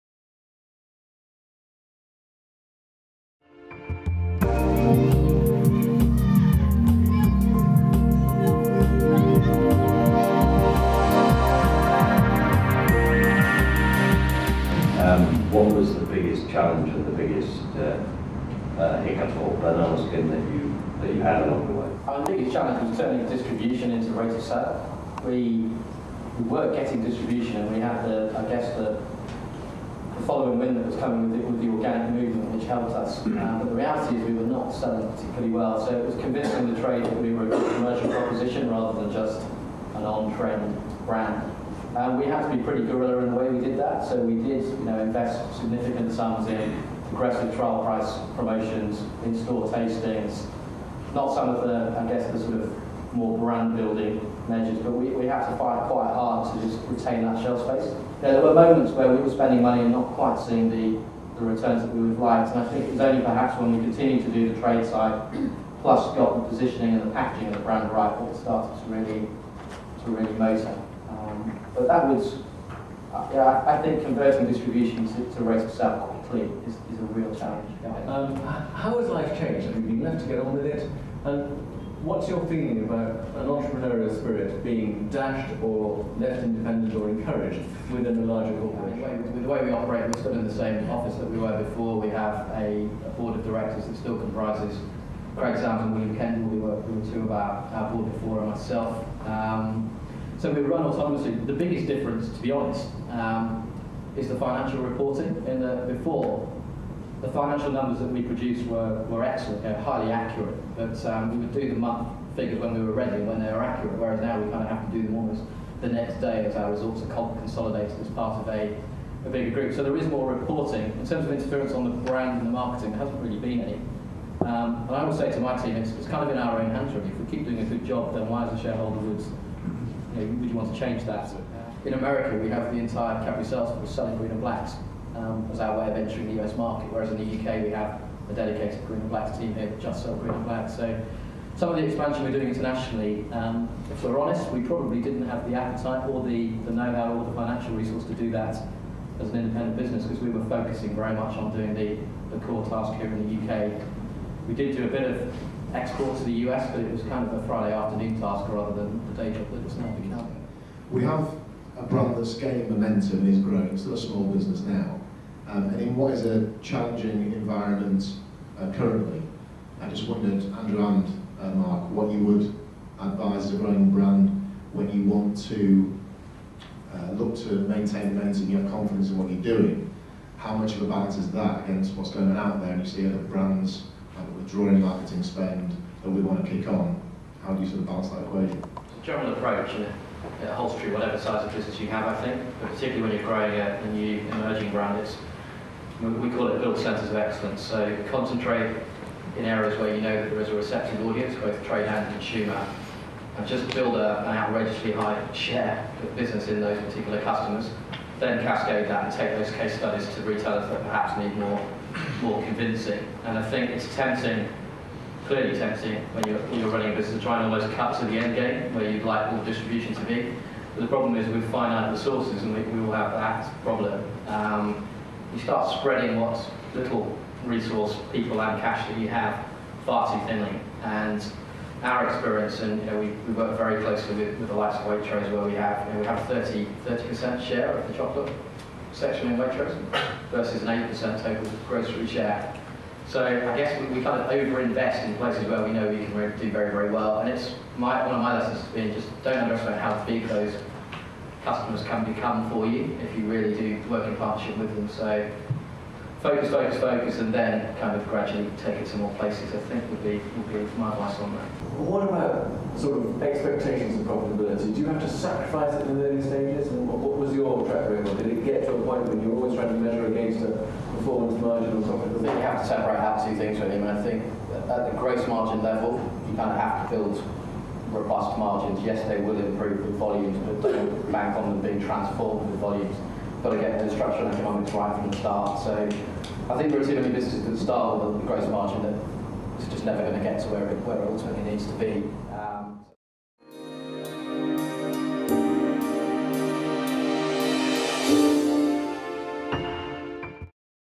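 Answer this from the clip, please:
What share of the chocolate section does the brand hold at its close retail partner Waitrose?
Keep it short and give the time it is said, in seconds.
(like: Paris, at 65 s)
30 percent, at 236 s.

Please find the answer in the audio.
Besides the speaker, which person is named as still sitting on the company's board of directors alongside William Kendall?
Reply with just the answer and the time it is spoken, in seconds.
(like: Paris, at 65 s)
Craig Sams, at 95 s.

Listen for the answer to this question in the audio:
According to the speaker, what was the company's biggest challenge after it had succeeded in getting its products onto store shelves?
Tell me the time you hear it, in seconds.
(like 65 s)
22 s.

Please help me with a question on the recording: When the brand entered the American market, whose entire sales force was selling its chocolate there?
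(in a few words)
Cadbury.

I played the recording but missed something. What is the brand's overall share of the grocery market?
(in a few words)
8%.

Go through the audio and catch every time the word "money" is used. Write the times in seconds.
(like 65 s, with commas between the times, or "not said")
59 s.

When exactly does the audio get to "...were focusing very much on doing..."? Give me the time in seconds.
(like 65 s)
150 s.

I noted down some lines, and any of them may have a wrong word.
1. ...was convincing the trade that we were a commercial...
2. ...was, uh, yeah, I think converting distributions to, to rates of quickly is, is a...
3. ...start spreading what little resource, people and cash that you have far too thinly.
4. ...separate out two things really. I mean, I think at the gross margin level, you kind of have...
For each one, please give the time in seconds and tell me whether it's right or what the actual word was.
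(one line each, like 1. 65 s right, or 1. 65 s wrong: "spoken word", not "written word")
1. 36 s right
2. 72 s right
3. 225 s right
4. 272 s right.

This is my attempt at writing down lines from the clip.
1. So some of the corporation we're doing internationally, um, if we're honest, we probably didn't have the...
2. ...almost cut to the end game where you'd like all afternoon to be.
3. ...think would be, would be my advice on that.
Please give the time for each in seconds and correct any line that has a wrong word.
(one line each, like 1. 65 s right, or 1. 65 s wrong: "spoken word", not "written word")
1. 140 s wrong: "expansion", not "corporation"
2. 217 s wrong: "distribution", not "afternoon"
3. 259 s right.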